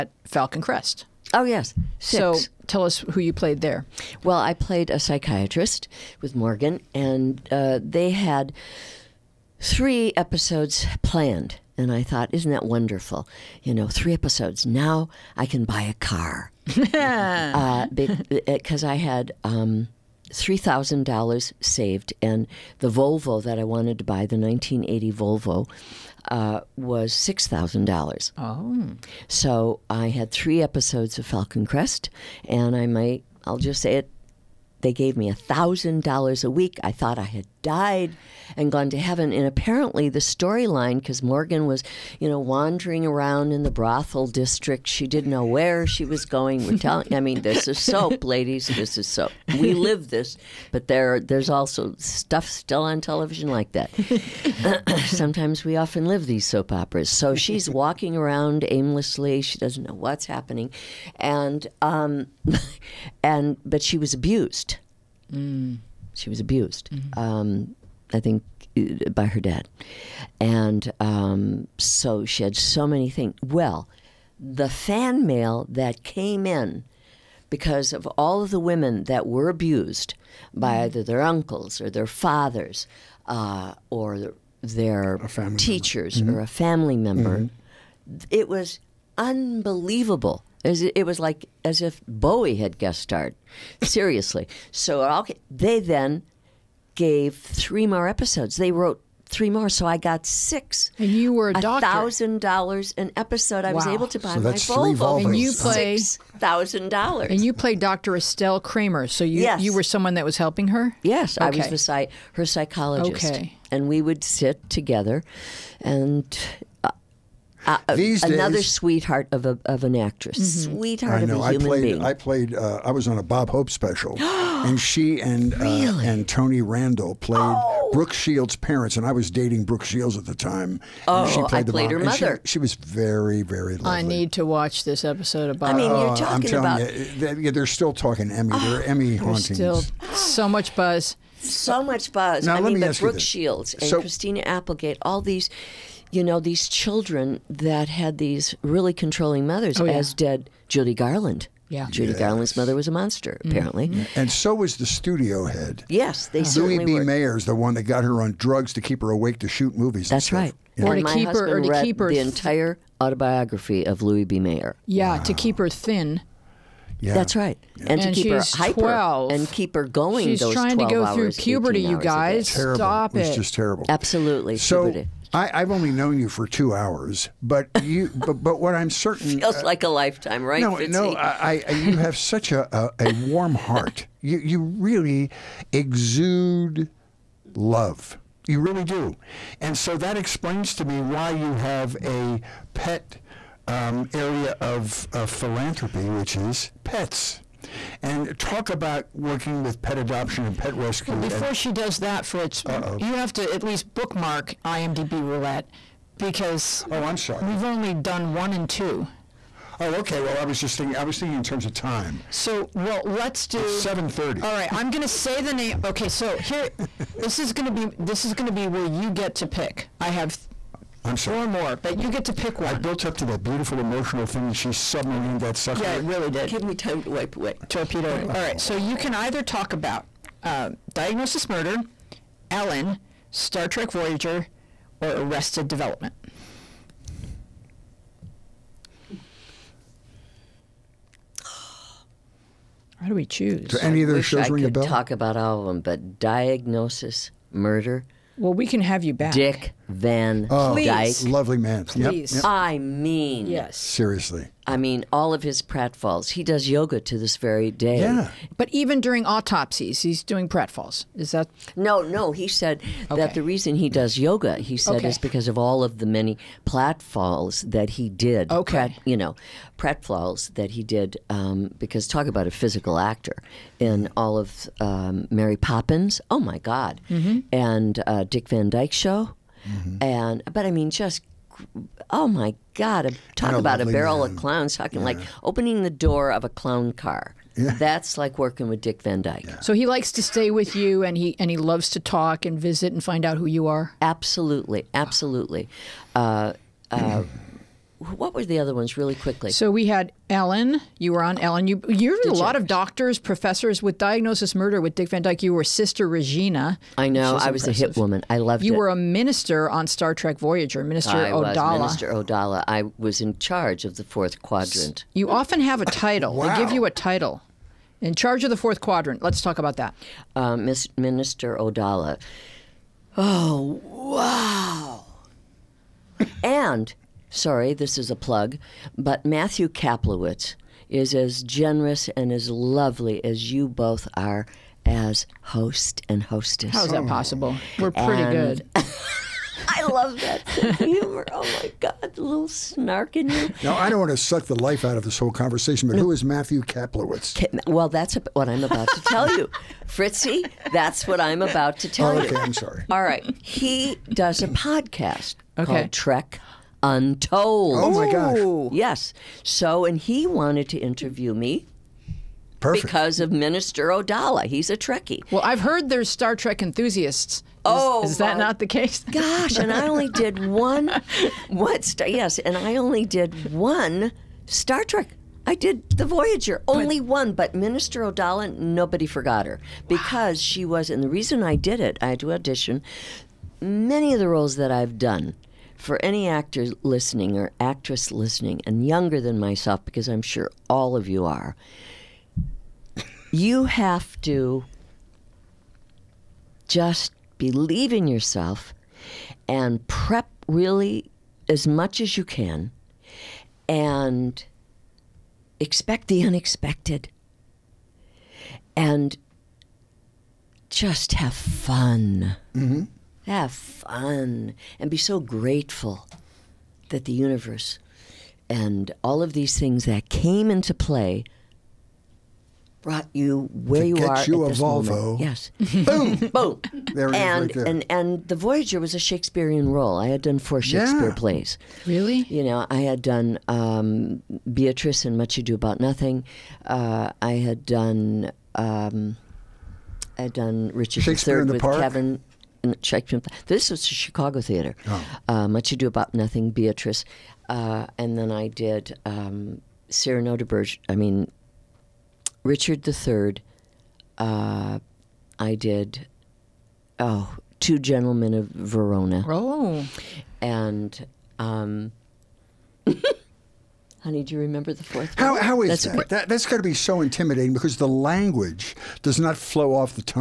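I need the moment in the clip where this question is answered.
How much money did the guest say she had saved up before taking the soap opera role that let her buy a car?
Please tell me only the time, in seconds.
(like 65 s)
20 s.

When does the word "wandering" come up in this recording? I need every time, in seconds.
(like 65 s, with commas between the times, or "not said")
42 s.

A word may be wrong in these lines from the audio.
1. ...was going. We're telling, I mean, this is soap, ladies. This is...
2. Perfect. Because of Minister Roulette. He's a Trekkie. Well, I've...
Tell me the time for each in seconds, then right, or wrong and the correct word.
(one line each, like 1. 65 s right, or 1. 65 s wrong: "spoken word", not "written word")
1. 46 s right
2. 362 s wrong: "Odala", not "Roulette".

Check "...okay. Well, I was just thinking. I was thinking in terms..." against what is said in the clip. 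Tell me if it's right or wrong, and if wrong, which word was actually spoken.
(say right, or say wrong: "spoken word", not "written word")
right.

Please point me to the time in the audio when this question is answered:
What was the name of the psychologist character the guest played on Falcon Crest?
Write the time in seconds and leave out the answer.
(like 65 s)
107 s.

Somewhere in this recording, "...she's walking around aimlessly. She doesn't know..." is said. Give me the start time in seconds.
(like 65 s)
57 s.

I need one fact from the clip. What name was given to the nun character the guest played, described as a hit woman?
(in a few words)
Sister Regina.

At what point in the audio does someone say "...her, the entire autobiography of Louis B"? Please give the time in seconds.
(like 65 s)
161 s.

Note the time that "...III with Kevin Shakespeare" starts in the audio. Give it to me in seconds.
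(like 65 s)
441 s.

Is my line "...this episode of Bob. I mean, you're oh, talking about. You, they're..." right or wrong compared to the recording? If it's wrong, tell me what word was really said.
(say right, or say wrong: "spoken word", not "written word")
right.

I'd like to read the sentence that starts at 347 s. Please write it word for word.
Well, that's what I'm about to tell you, Fritzy.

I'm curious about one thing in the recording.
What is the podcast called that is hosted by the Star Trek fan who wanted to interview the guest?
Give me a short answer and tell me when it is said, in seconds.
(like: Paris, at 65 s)
Trek Untold, at 355 s.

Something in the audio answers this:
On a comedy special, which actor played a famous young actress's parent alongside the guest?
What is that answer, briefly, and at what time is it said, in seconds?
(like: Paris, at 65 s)
Tony Randall, at 126 s.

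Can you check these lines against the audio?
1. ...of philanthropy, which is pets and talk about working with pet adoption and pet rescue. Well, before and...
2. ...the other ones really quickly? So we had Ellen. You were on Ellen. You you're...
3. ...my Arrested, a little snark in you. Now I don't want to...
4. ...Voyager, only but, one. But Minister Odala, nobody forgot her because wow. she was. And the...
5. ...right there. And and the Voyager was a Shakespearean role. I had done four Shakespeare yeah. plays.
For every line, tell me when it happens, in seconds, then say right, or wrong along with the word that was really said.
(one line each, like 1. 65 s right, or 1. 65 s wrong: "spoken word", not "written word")
1. 195 s right
2. 298 s right
3. 341 s wrong: "God", not "Arrested"
4. 376 s right
5. 427 s right.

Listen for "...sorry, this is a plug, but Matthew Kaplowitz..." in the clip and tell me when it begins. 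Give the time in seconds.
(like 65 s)
327 s.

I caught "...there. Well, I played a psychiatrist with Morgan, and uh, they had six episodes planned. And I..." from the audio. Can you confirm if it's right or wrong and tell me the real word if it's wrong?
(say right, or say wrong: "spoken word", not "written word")
wrong: "three", not "six".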